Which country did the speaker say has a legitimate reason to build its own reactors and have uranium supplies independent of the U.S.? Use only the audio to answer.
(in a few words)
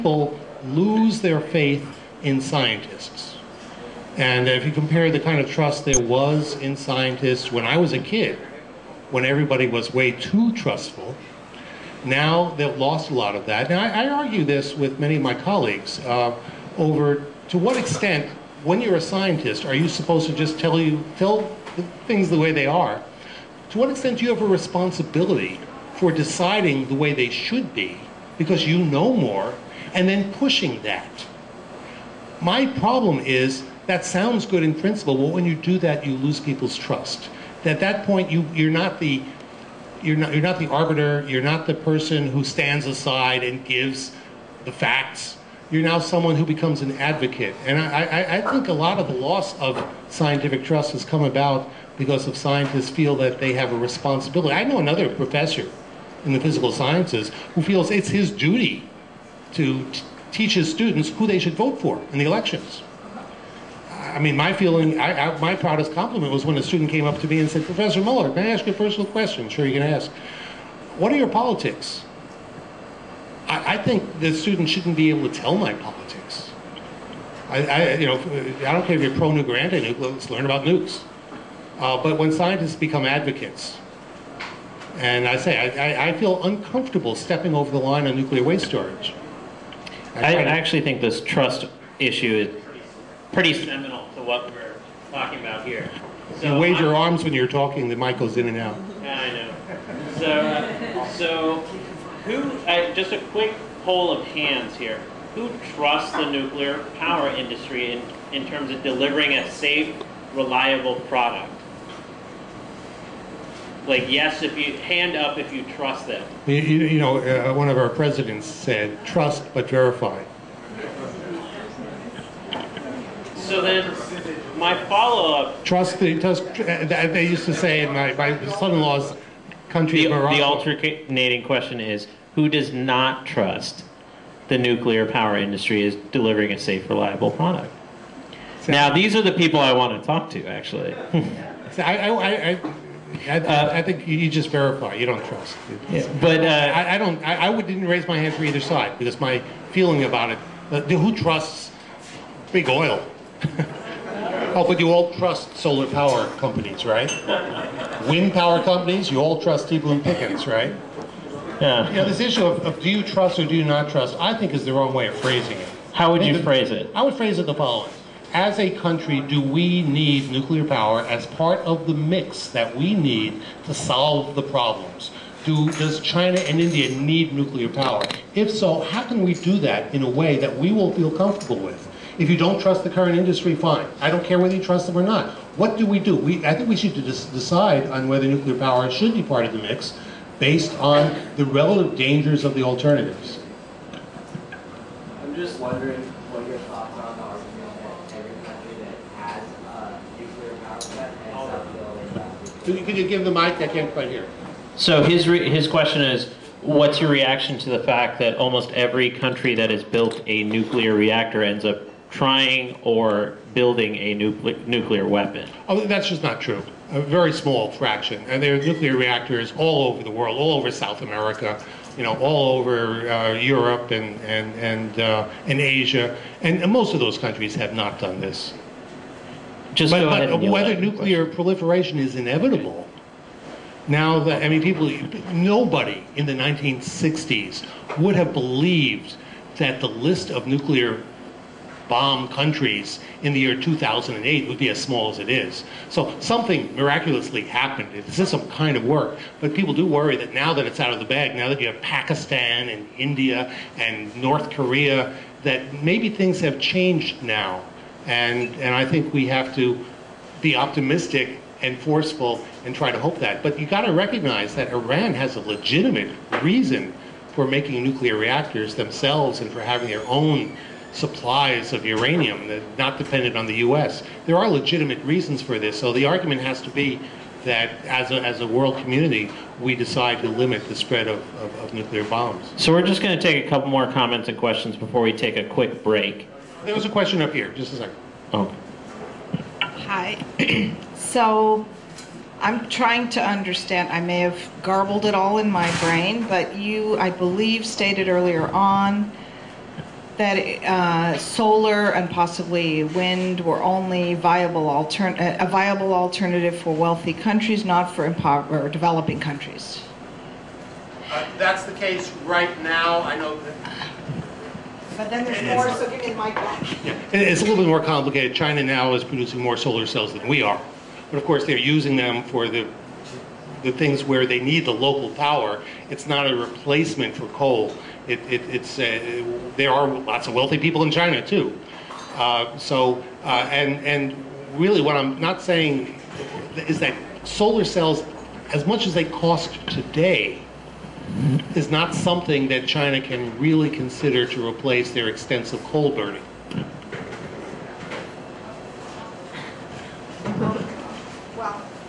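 Iran.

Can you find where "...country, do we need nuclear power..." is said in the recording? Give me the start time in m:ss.
2:48.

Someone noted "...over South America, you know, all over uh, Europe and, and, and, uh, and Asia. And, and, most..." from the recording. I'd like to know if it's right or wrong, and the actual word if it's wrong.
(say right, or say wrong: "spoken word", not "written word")
right.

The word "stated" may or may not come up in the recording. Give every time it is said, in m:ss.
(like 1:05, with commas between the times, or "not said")
4:57.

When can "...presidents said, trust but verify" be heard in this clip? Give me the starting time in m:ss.
1:57.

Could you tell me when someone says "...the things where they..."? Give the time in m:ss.
5:23.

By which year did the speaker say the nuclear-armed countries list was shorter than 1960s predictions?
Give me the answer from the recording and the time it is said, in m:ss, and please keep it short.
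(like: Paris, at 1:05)
2008, at 4:03.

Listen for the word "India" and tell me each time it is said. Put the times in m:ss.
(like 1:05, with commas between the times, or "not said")
2:56, 4:12.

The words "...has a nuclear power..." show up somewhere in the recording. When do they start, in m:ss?
3:19.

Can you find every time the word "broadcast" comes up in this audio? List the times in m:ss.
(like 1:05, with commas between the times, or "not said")
not said.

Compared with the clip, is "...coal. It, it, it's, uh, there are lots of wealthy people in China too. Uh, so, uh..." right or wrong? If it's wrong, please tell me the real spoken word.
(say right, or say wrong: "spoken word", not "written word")
right.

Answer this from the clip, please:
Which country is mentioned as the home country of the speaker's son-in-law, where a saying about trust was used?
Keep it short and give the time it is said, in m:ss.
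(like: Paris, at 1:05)
Morocco, at 2:10.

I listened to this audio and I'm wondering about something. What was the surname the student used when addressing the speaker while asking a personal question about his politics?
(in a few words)
Muller.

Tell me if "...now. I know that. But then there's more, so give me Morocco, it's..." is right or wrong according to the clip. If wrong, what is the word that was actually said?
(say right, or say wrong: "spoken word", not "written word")
wrong: "Yeah", not "Morocco".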